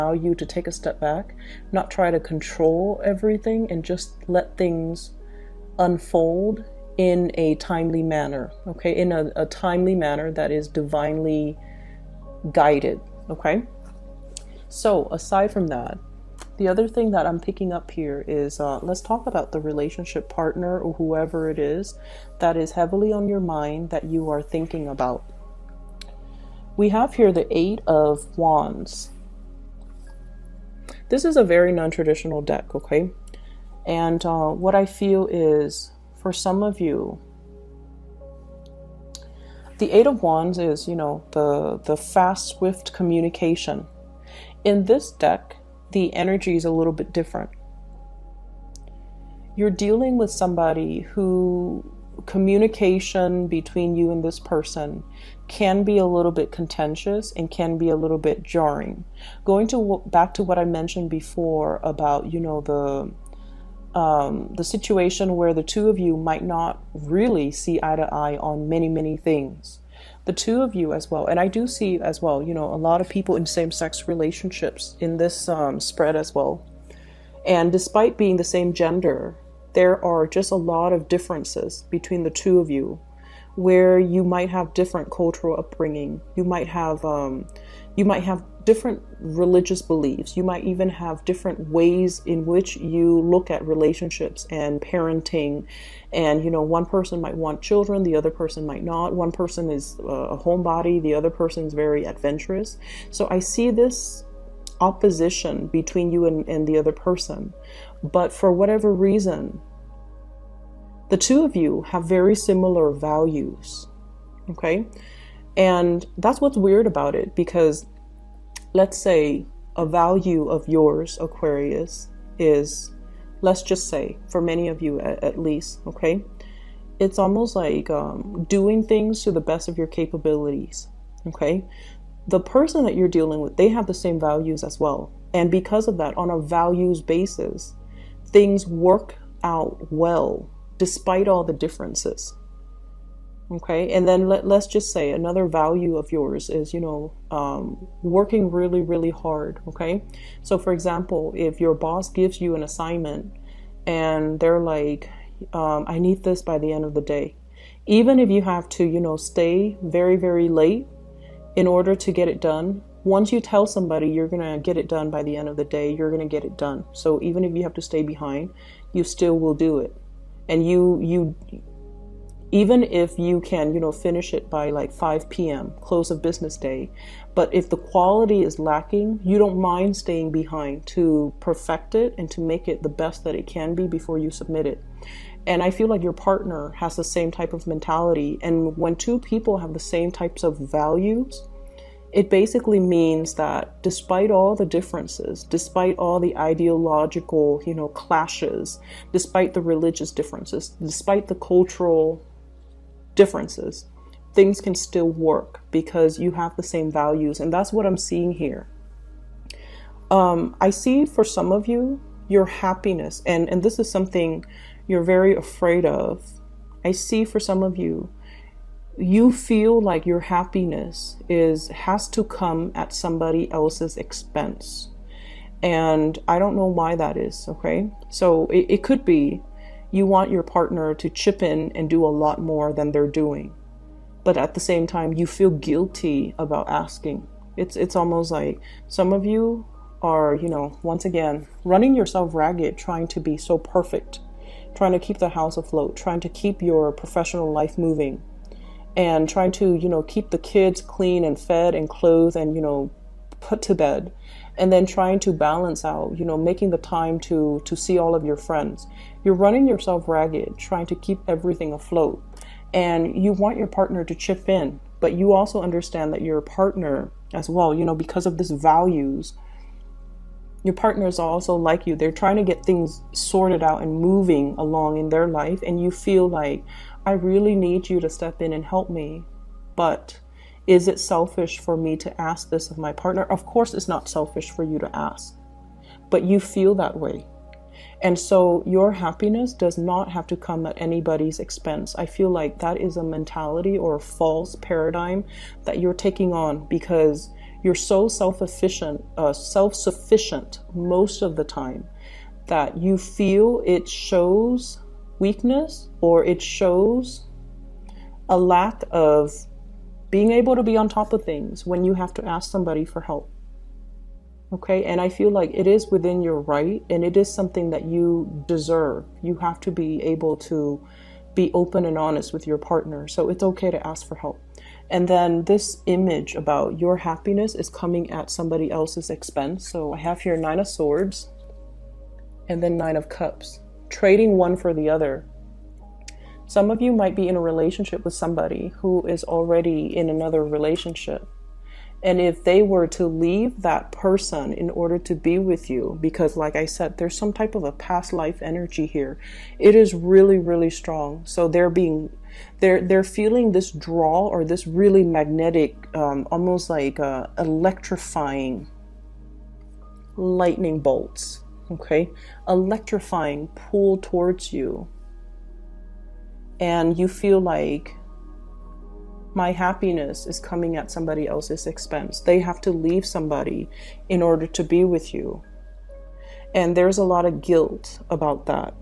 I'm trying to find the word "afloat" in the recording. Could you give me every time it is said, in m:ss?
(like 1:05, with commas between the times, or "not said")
4:05, 4:21.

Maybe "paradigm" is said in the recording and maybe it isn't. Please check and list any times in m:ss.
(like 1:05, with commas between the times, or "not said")
4:54.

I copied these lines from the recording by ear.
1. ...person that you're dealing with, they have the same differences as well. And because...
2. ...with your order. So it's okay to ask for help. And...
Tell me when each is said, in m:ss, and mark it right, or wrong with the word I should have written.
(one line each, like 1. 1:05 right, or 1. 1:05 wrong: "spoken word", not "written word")
1. 2:12 wrong: "values", not "differences"
2. 5:22 wrong: "partner", not "order".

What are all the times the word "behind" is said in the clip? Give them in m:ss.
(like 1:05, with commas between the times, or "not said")
2:48, 3:00.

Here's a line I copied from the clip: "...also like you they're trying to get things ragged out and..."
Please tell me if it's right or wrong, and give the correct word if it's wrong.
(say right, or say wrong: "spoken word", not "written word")
wrong: "sorted", not "ragged".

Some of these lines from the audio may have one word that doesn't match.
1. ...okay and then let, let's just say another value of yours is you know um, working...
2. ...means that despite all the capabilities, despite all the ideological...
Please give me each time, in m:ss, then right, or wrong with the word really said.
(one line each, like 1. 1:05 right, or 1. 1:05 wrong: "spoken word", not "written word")
1. 2:23 right
2. 3:12 wrong: "differences", not "capabilities".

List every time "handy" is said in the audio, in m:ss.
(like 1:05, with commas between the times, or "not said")
not said.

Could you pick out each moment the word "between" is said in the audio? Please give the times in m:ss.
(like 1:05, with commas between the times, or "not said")
0:53, 1:21, 1:45.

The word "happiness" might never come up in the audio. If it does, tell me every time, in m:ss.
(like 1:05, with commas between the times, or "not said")
3:32, 3:40, 4:48, 5:26, 6:09.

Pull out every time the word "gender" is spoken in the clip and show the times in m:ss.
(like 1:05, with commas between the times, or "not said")
1:18.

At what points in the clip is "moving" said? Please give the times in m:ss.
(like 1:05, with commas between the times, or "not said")
4:07, 4:34.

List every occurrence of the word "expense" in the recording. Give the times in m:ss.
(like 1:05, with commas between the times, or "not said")
3:43, 4:51, 5:29, 6:11.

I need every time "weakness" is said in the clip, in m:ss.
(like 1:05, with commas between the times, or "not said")
5:05.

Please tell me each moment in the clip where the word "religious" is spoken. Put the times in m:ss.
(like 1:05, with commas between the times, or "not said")
1:29, 3:19.